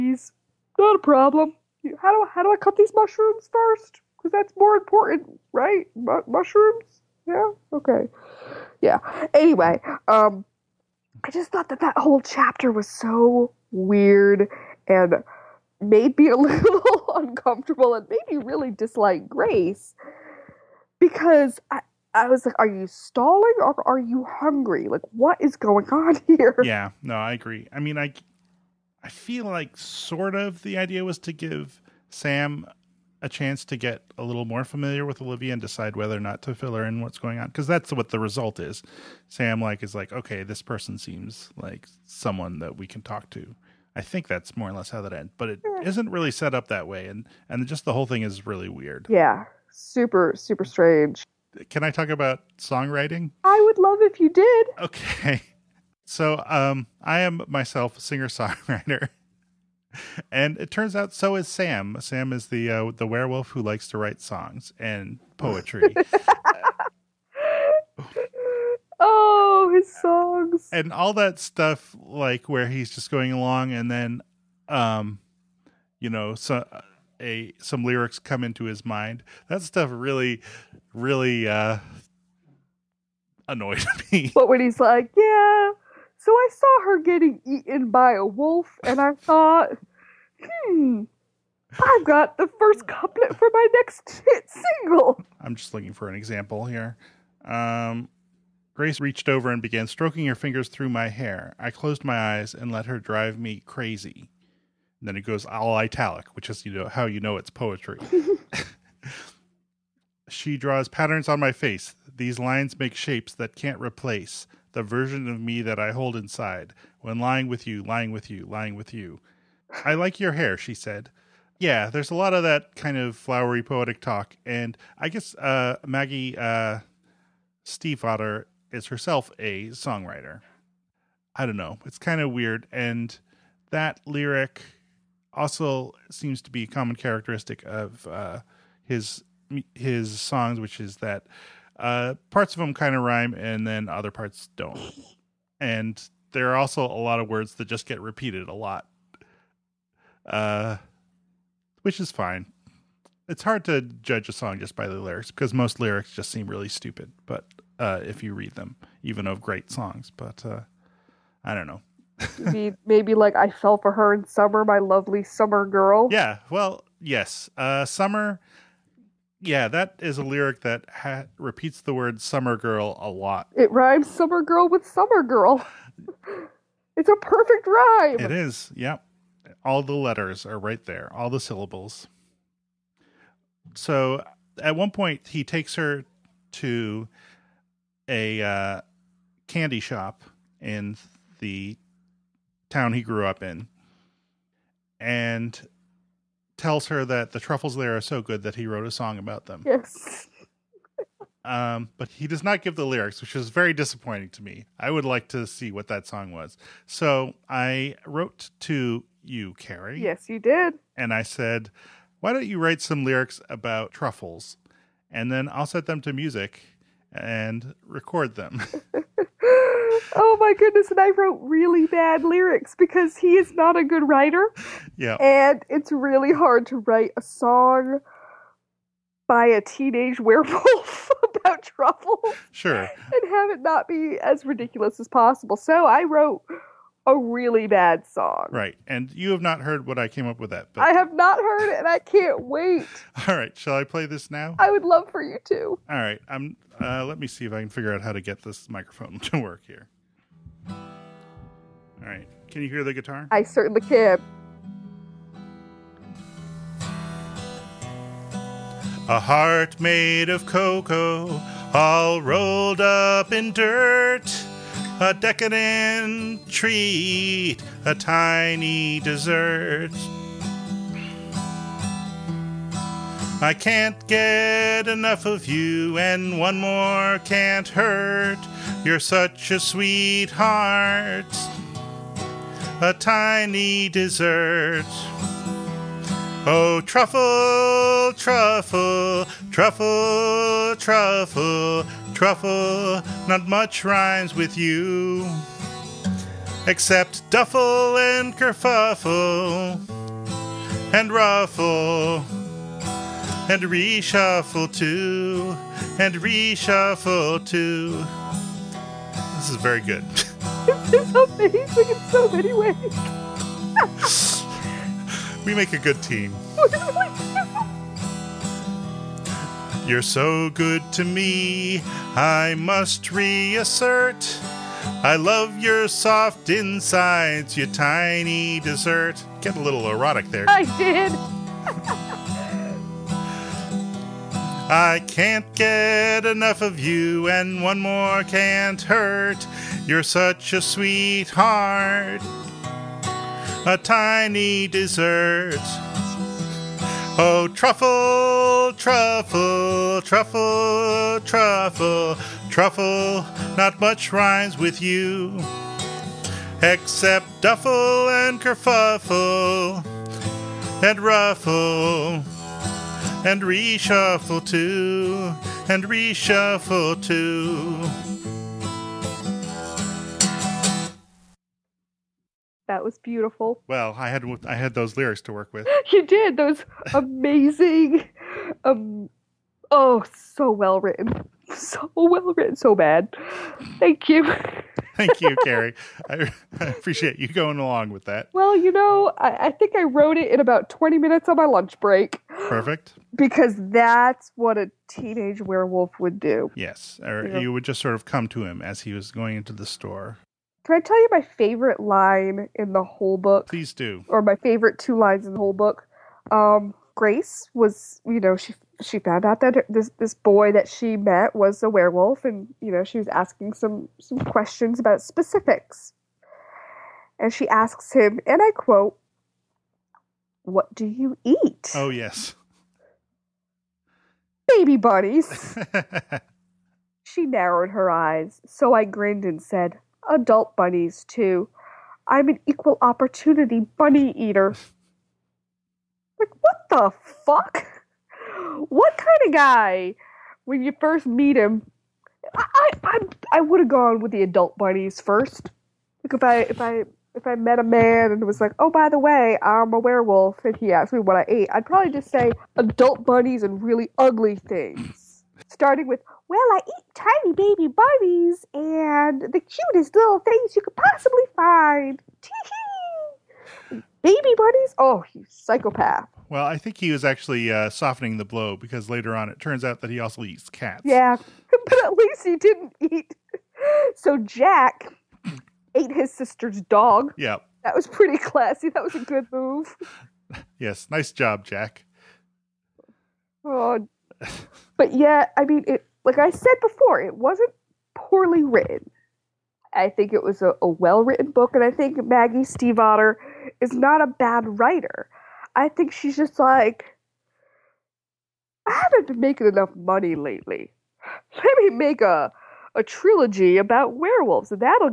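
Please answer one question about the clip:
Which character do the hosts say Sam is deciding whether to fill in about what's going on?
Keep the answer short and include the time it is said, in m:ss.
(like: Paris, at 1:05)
Olivia, at 0:35.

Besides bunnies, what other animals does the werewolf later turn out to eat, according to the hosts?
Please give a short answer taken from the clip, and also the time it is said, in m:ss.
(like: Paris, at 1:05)
Cats, at 7:50.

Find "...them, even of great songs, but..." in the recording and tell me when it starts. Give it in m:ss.
2:38.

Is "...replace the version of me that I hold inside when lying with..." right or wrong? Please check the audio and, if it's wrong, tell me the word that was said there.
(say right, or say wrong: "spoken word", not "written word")
right.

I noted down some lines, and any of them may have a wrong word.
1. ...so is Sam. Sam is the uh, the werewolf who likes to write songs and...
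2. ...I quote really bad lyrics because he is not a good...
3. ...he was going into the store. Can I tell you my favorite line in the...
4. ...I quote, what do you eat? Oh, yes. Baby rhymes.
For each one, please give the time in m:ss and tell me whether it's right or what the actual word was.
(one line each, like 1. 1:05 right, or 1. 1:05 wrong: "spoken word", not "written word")
1. 1:01 right
2. 3:40 wrong: "wrote", not "quote"
3. 6:38 right
4. 6:58 wrong: "bunnies", not "rhymes".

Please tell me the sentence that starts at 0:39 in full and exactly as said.
Sam like is like, okay, this person seems like someone that we can talk to.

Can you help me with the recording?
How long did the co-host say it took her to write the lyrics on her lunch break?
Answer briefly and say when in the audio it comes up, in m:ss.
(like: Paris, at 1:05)
20 minutes, at 6:30.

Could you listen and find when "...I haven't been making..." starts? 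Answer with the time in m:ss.
8:18.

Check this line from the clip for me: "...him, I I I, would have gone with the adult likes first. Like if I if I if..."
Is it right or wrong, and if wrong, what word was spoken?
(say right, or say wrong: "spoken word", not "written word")
wrong: "bunnies", not "likes".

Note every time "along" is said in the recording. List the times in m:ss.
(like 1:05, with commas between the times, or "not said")
1:13, 6:27.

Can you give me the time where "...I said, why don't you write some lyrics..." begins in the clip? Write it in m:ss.
3:31.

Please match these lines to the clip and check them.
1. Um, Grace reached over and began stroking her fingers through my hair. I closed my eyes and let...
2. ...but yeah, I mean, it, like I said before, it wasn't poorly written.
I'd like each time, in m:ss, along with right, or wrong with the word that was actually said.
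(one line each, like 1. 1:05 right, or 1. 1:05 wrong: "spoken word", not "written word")
1. 1:37 right
2. 8:04 right.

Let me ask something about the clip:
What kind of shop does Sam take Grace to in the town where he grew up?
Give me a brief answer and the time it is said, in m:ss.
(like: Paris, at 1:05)
Candy shop, at 3:09.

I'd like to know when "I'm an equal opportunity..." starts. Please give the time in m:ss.
7:12.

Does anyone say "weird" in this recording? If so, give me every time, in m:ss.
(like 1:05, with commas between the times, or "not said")
0:13, 0:48, 2:12.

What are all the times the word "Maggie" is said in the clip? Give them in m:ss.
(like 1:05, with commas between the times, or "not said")
2:05, 8:12.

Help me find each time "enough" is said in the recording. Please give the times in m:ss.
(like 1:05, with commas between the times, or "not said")
4:34, 5:36, 8:19.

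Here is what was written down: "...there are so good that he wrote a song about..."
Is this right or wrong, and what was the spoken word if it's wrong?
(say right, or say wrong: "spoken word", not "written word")
right.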